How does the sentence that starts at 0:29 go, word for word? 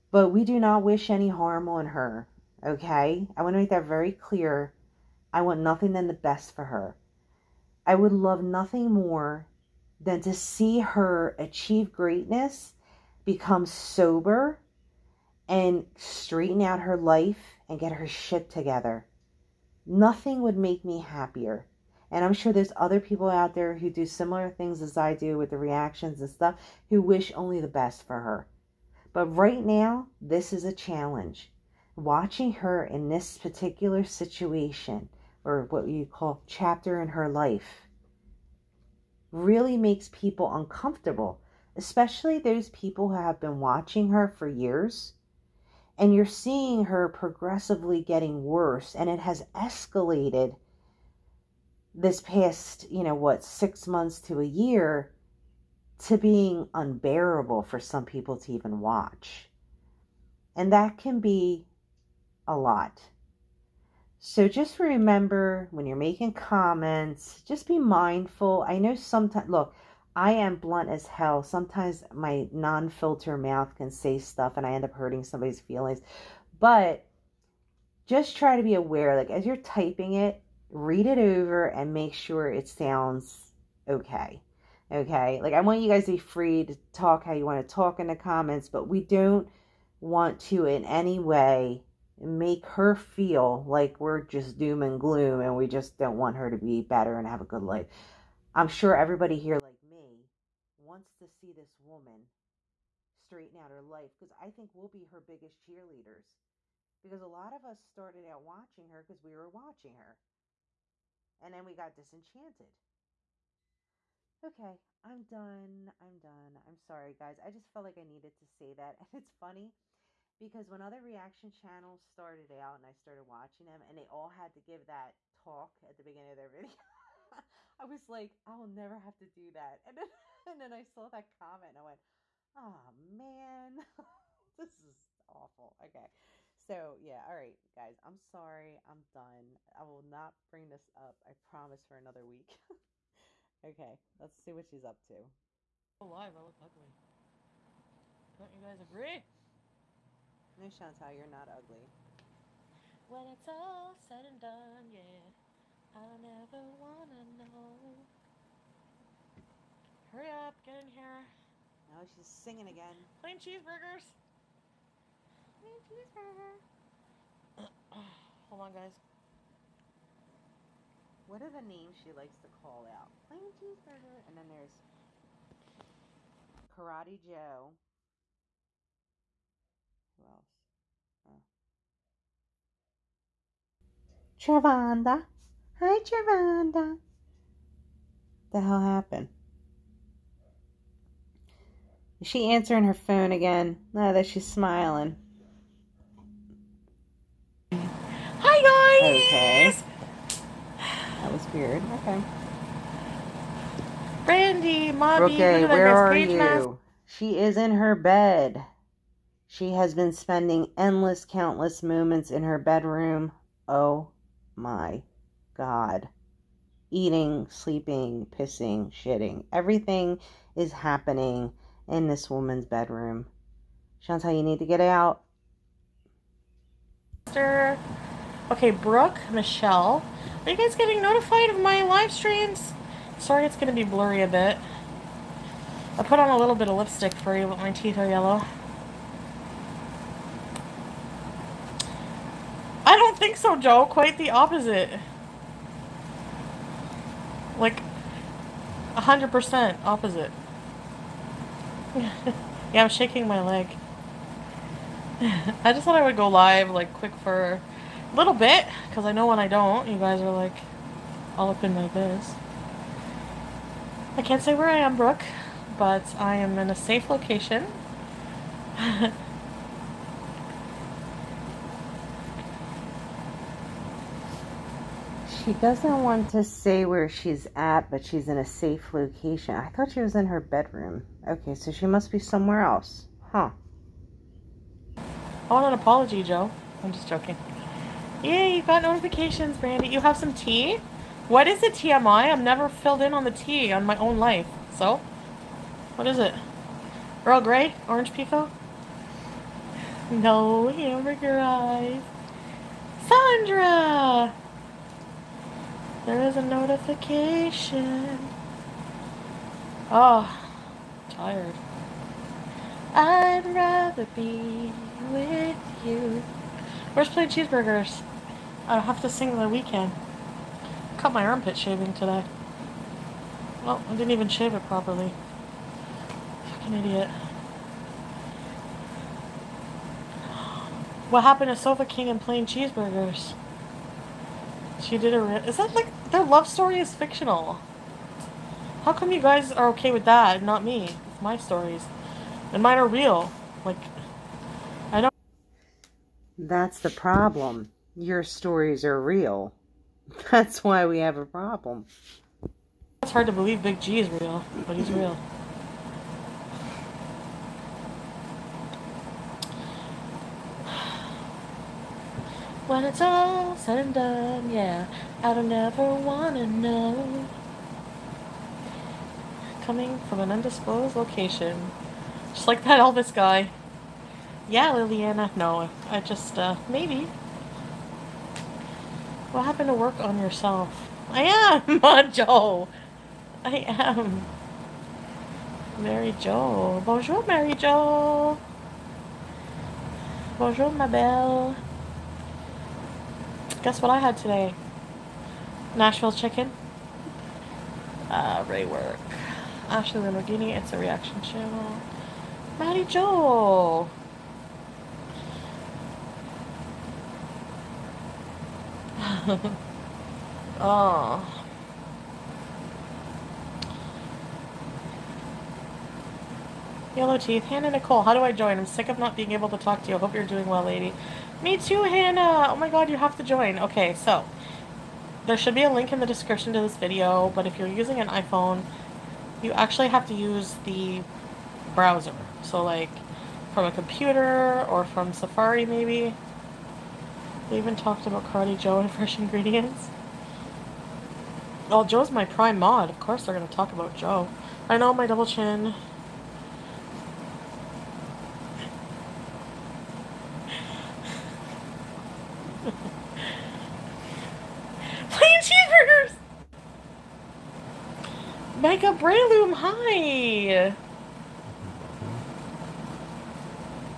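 But right now, this is a challenge.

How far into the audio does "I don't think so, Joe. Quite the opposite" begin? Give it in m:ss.
4:02.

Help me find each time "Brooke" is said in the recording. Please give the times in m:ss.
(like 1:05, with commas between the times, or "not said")
3:48, 4:24.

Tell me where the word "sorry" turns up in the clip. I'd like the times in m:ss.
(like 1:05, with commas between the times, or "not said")
1:56, 2:18, 3:53.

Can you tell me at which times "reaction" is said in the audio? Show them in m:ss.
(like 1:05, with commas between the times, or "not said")
0:25, 2:01, 6:40.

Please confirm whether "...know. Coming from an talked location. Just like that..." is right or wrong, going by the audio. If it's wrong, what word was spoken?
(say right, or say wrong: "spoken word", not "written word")
wrong: "undisclosed", not "talked".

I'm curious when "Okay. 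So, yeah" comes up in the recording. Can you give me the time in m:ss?
2:15.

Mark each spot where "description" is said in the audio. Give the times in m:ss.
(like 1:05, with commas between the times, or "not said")
7:06.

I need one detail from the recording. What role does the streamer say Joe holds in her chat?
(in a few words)
Prime mod.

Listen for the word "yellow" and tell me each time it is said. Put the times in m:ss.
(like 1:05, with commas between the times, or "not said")
3:58, 6:56.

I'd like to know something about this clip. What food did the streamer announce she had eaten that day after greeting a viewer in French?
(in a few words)
Nashville chicken.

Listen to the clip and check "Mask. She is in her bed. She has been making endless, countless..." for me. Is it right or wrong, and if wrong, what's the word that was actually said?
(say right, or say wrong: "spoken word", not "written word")
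wrong: "spending", not "making".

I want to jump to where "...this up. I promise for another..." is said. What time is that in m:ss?
2:20.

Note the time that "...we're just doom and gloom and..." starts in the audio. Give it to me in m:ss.
1:33.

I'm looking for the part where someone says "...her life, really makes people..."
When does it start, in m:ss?
0:37.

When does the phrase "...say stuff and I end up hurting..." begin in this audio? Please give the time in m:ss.
1:13.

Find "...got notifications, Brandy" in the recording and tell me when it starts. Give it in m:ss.
4:48.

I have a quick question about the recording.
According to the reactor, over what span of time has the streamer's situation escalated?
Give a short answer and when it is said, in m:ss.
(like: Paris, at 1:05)
6 months to a year, at 0:53.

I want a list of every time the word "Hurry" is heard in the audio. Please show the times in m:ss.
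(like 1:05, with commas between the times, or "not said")
2:40.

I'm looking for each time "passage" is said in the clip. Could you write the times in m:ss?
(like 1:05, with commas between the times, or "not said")
not said.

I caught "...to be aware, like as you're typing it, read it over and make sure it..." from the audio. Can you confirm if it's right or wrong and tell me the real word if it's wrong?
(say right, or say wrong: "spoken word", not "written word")
right.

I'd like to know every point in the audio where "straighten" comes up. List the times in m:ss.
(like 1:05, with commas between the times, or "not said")
0:15, 1:43.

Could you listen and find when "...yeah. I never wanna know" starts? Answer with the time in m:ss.
2:34.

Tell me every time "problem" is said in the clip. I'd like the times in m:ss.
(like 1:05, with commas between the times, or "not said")
5:46, 5:51.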